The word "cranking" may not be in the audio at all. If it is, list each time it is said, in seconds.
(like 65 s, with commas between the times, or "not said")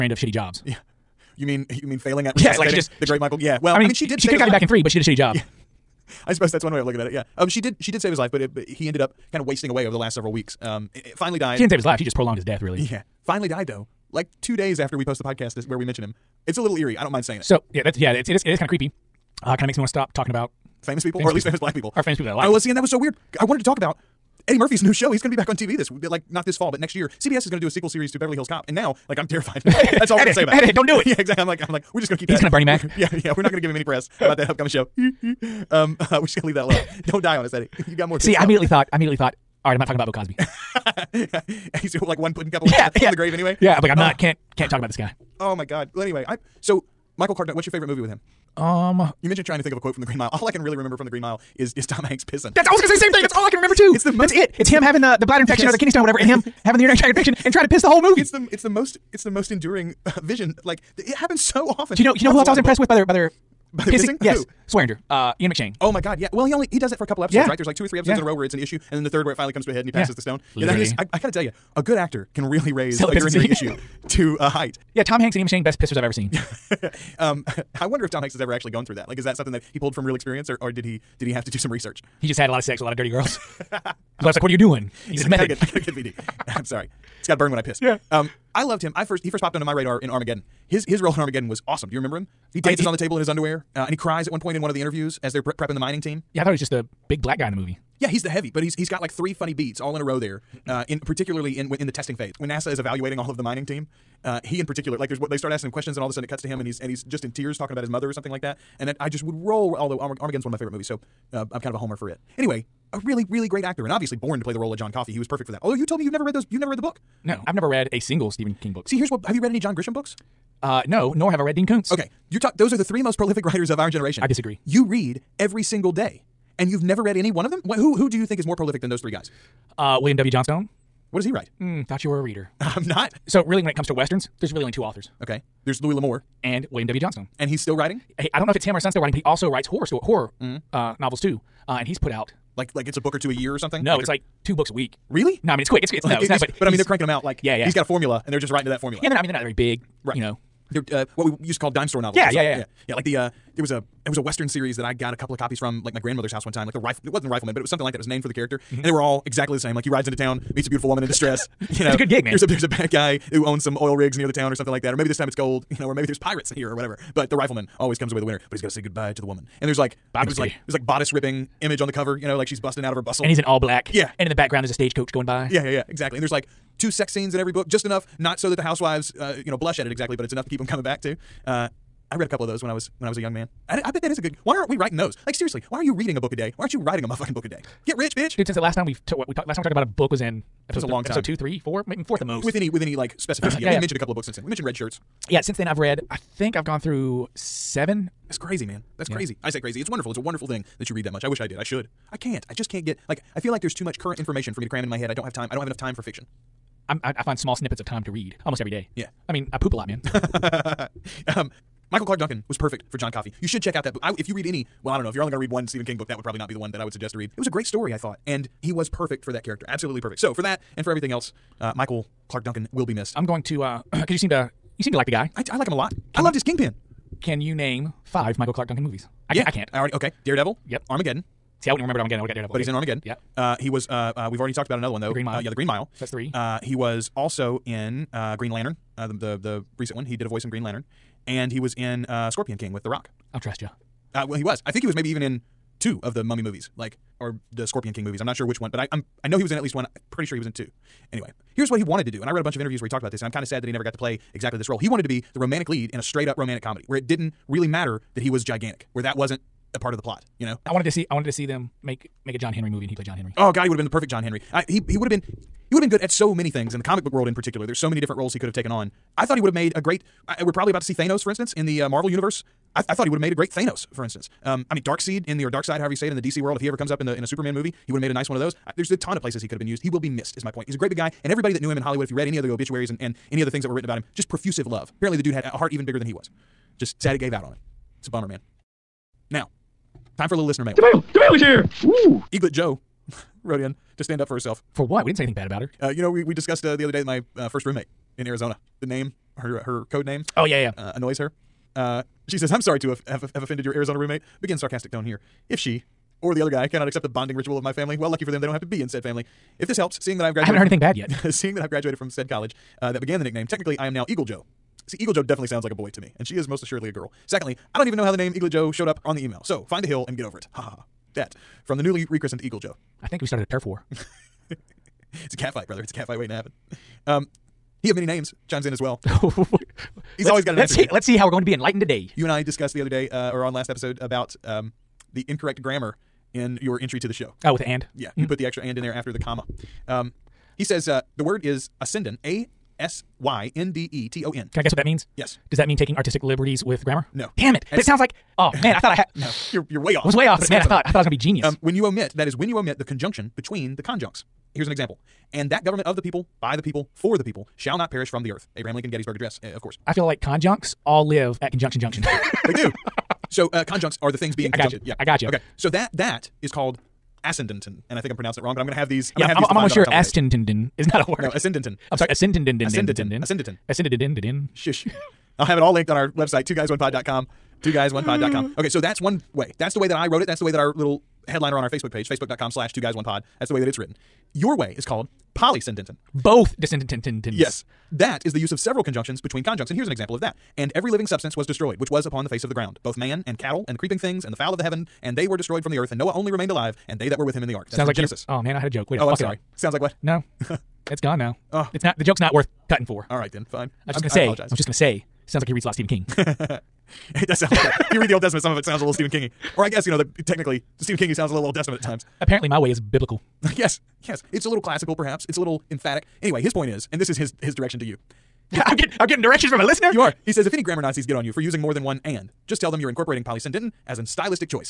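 146 s.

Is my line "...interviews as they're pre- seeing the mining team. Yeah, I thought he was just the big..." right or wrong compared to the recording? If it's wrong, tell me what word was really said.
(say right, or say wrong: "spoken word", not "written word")
wrong: "prepping", not "seeing".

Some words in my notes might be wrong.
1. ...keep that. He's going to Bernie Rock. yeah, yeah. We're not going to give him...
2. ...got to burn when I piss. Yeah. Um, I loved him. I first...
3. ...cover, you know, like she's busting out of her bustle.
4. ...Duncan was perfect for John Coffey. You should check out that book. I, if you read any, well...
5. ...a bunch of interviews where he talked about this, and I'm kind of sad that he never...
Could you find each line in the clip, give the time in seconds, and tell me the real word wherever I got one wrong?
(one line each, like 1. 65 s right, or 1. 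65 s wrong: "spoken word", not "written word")
1. 32 s wrong: "Mac", not "Rock"
2. 87 s right
3. 171 s right
4. 212 s right
5. 252 s right.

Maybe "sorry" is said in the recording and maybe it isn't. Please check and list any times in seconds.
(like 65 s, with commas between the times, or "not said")
86 s, 302 s, 371 s, 399 s.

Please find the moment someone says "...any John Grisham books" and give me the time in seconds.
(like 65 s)
119 s.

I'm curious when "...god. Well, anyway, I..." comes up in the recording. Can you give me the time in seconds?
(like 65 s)
45 s.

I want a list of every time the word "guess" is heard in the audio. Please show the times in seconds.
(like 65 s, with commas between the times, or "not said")
344 s, 409 s.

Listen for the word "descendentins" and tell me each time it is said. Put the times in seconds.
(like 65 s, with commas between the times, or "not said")
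386 s.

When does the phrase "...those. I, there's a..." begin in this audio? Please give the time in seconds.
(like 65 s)
278 s.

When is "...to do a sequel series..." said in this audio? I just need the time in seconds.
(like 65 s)
27 s.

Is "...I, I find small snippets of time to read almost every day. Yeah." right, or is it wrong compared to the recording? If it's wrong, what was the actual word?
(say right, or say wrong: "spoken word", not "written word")
right.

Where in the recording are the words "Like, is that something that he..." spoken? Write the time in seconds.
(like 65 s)
79 s.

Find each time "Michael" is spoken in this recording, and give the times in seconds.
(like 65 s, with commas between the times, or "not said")
3 s, 47 s, 211 s, 221 s, 228 s.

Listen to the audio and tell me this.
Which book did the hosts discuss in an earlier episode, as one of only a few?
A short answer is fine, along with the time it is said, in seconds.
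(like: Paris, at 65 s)
Red Shirts, at 194 s.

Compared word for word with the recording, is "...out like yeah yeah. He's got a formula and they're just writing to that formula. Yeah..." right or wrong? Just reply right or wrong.
right.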